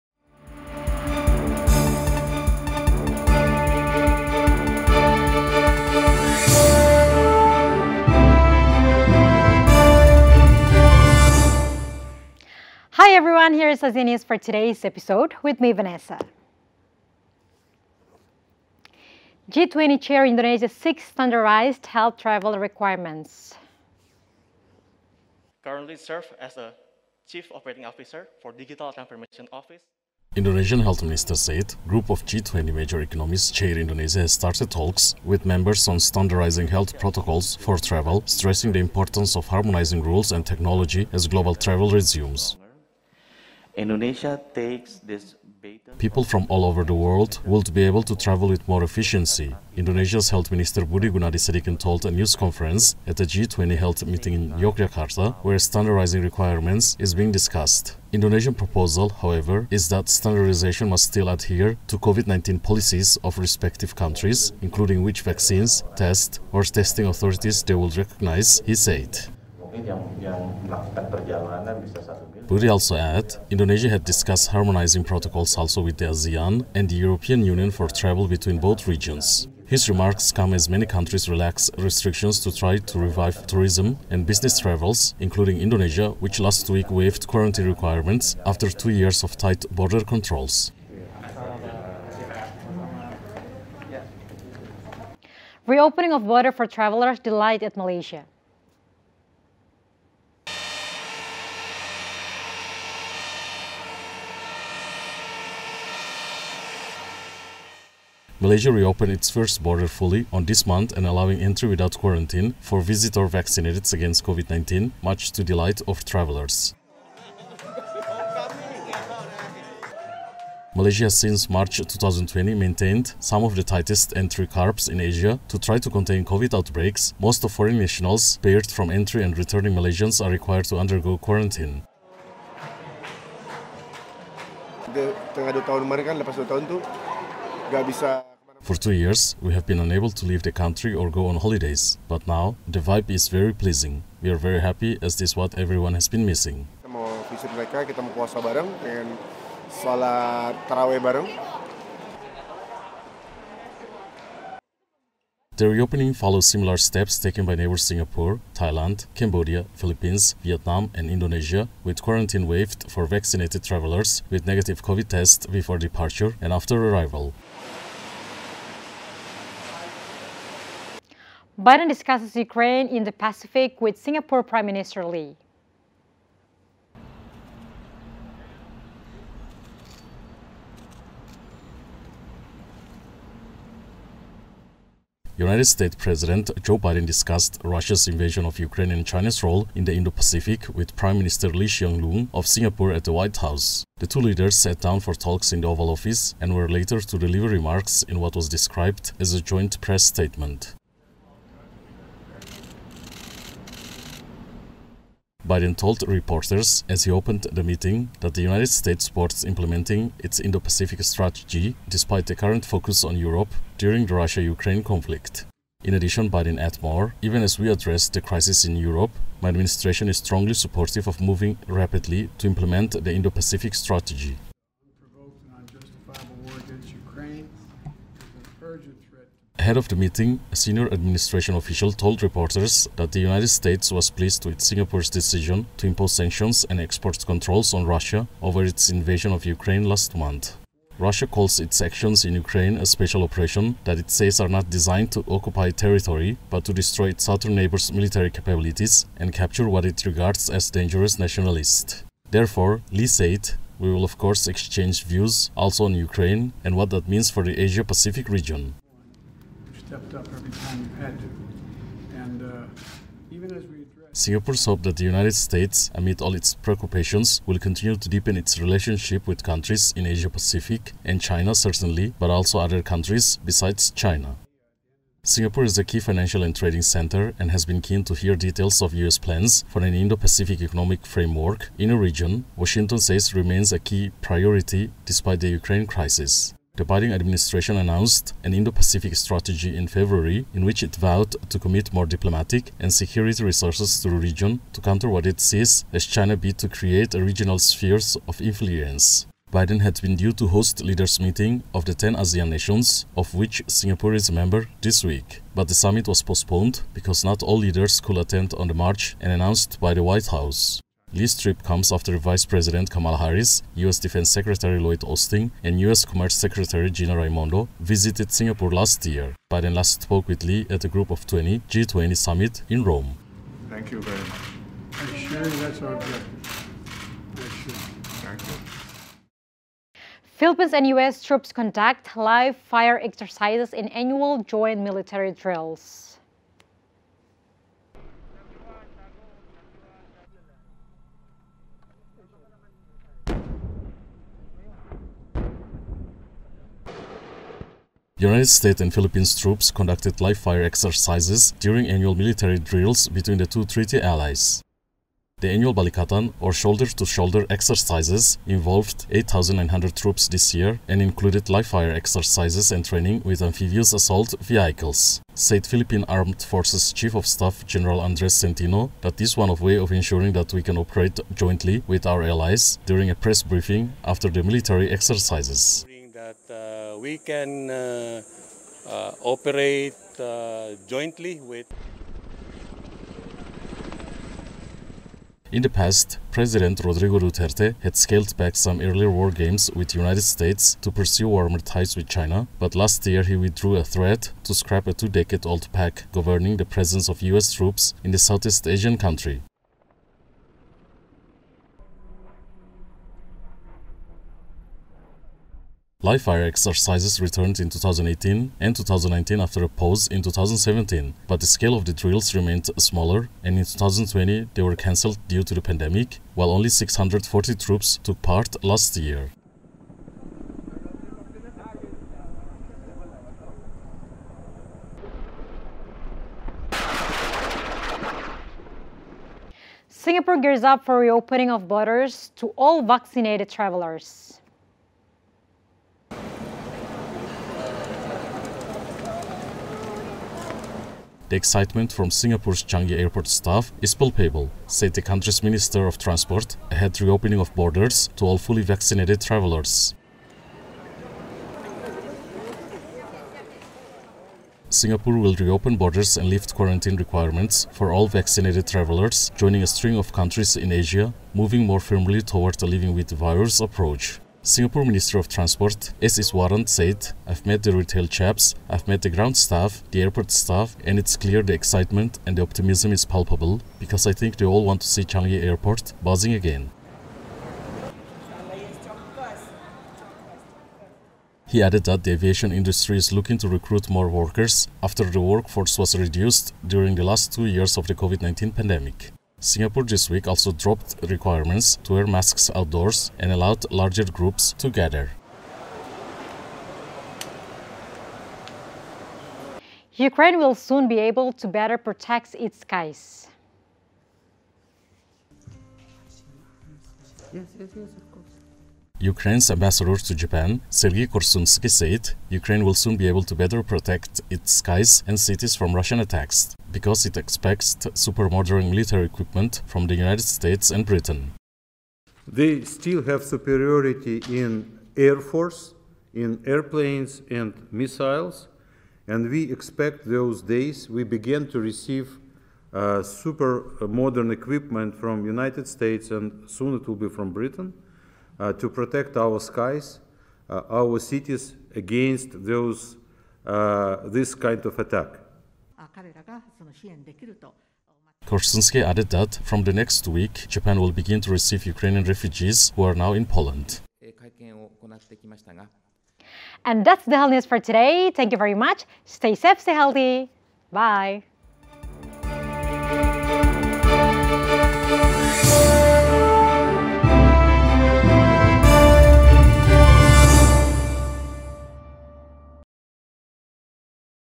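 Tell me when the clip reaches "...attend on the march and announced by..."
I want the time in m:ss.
5:08.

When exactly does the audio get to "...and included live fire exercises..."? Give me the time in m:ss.
6:00.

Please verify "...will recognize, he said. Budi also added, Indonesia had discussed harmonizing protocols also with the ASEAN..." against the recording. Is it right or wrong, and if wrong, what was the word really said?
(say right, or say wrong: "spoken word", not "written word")
right.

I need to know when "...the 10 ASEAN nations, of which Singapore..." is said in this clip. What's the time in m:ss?
5:01.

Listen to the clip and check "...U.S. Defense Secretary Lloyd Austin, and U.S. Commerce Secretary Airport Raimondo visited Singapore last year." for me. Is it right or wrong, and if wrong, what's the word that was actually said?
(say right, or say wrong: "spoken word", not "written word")
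wrong: "Gina", not "Airport".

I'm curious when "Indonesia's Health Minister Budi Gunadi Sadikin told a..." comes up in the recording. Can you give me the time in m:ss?
0:49.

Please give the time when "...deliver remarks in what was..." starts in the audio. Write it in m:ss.
3:17.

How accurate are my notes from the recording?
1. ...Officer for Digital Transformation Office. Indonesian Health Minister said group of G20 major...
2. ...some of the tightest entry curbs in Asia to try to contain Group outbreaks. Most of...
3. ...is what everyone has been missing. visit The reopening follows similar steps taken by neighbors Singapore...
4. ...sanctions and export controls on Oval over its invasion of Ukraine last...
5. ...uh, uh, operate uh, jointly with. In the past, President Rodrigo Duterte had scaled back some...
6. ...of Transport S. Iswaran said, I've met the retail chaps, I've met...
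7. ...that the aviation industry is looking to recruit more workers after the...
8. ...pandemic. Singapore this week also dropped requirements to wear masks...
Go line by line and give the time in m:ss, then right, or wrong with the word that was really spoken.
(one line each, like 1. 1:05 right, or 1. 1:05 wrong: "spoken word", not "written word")
1. 0:27 right
2. 2:03 wrong: "COVID", not "Group"
3. 2:25 right
4. 3:56 wrong: "Russia", not "Oval"
5. 6:17 right
6. 7:45 right
7. 8:01 right
8. 8:08 right.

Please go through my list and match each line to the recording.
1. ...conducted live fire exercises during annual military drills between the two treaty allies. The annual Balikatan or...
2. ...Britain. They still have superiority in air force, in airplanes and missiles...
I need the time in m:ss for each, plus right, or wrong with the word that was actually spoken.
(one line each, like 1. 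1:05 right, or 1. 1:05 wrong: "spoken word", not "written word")
1. 5:49 right
2. 8:40 right.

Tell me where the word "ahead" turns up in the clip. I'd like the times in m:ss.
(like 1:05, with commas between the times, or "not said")
3:49, 7:26.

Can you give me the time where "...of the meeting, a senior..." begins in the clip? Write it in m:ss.
3:49.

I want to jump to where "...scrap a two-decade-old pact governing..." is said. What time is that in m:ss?
6:34.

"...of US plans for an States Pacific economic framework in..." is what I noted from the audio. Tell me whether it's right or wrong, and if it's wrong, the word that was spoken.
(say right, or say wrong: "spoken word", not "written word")
wrong: "Indo", not "States".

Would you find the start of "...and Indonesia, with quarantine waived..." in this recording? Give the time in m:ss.
2:40.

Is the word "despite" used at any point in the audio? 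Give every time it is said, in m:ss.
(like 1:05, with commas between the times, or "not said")
3:31, 4:45.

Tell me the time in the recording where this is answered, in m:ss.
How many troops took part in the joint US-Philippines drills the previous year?
6:56.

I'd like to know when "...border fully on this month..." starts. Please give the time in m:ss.
1:49.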